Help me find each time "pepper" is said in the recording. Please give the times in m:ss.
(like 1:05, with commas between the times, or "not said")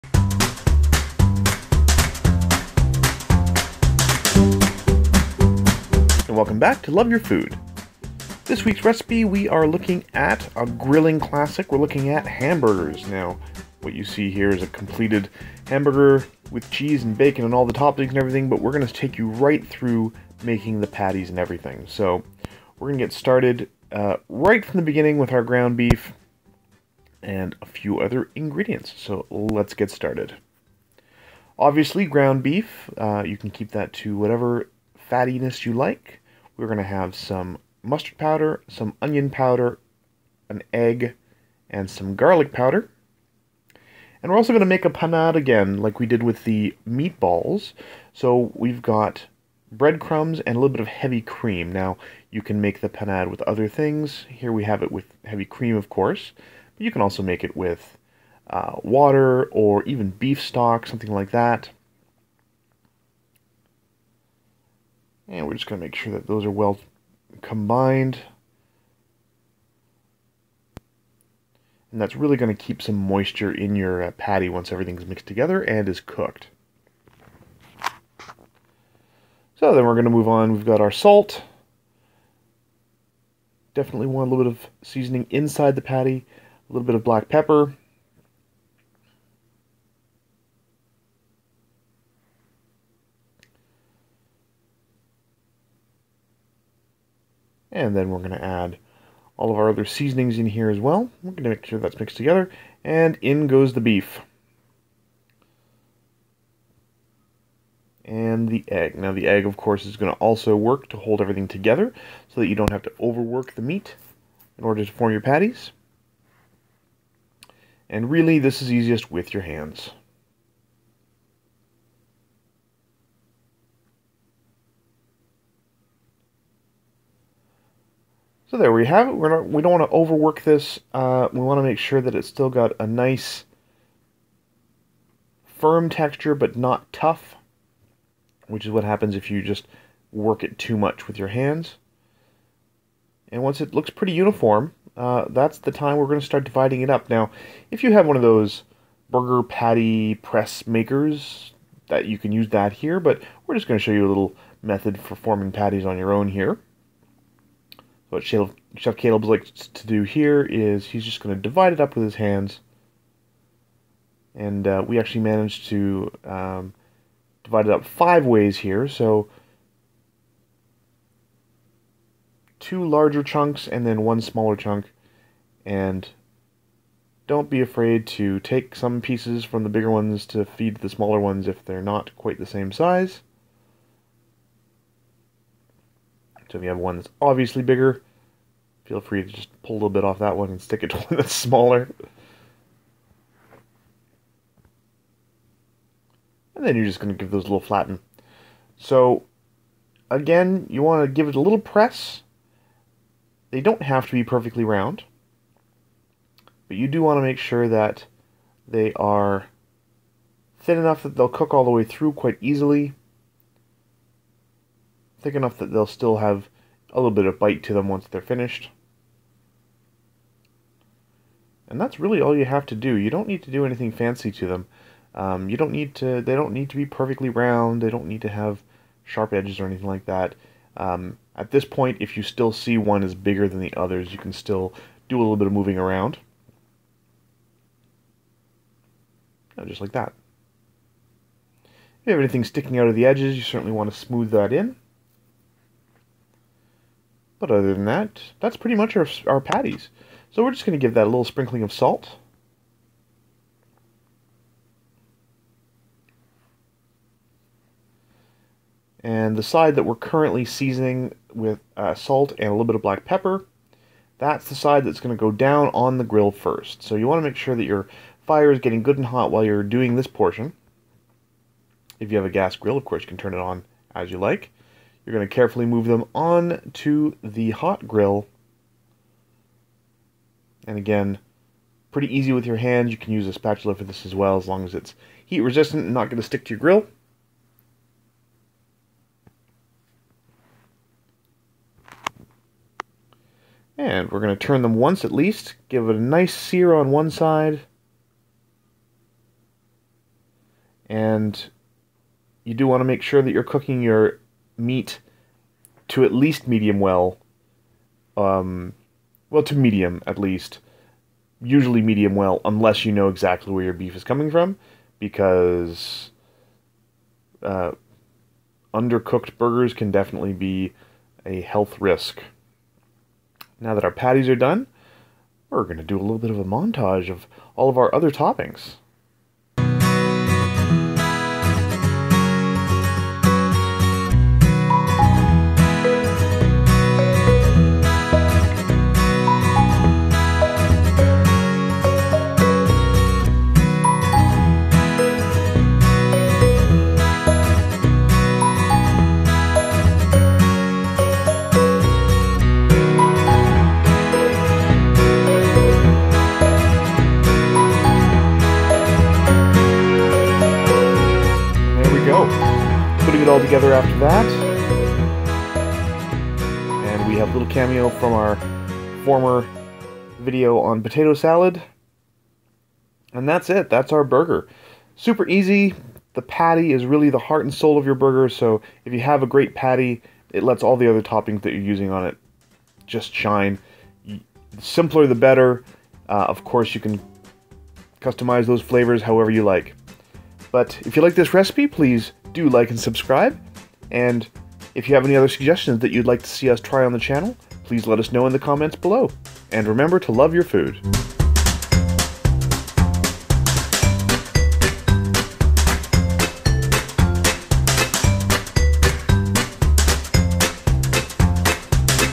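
1:27, 4:23.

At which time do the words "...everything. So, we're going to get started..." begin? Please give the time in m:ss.
0:21.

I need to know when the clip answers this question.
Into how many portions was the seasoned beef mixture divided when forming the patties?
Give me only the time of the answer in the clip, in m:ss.
2:47.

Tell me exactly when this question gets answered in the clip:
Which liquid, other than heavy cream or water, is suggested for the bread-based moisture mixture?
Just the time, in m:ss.
1:00.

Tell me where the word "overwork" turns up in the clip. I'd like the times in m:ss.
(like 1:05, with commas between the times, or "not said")
1:52, 2:09.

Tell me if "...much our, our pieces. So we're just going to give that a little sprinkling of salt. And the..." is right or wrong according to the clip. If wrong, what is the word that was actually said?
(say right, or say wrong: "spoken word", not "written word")
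wrong: "patties", not "pieces".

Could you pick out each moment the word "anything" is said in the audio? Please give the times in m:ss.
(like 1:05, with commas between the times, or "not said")
3:43, 3:49, 4:02.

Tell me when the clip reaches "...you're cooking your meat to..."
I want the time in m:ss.
5:03.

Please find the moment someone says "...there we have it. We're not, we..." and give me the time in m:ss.
2:08.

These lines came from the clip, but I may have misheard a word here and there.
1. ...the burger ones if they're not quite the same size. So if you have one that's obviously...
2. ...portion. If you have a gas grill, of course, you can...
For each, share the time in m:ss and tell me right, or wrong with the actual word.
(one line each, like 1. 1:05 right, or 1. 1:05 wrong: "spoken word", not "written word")
1. 3:00 wrong: "smaller", not "burger"
2. 4:30 right.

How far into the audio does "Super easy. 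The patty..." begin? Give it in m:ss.
6:14.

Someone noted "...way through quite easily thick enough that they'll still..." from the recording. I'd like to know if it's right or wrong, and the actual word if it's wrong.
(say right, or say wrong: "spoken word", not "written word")
right.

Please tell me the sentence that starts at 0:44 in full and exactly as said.
And we're also going to make a panade again, like we did with the meatballs.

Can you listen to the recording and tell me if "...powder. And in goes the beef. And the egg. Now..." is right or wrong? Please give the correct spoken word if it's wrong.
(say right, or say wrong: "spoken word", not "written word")
wrong: "together", not "powder".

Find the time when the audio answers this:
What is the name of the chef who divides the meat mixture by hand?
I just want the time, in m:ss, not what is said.
2:38.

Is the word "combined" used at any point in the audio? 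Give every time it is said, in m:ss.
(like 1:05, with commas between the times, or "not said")
1:07.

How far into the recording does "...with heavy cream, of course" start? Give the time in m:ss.
0:54.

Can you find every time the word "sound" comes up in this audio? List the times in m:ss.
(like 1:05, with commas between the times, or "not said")
not said.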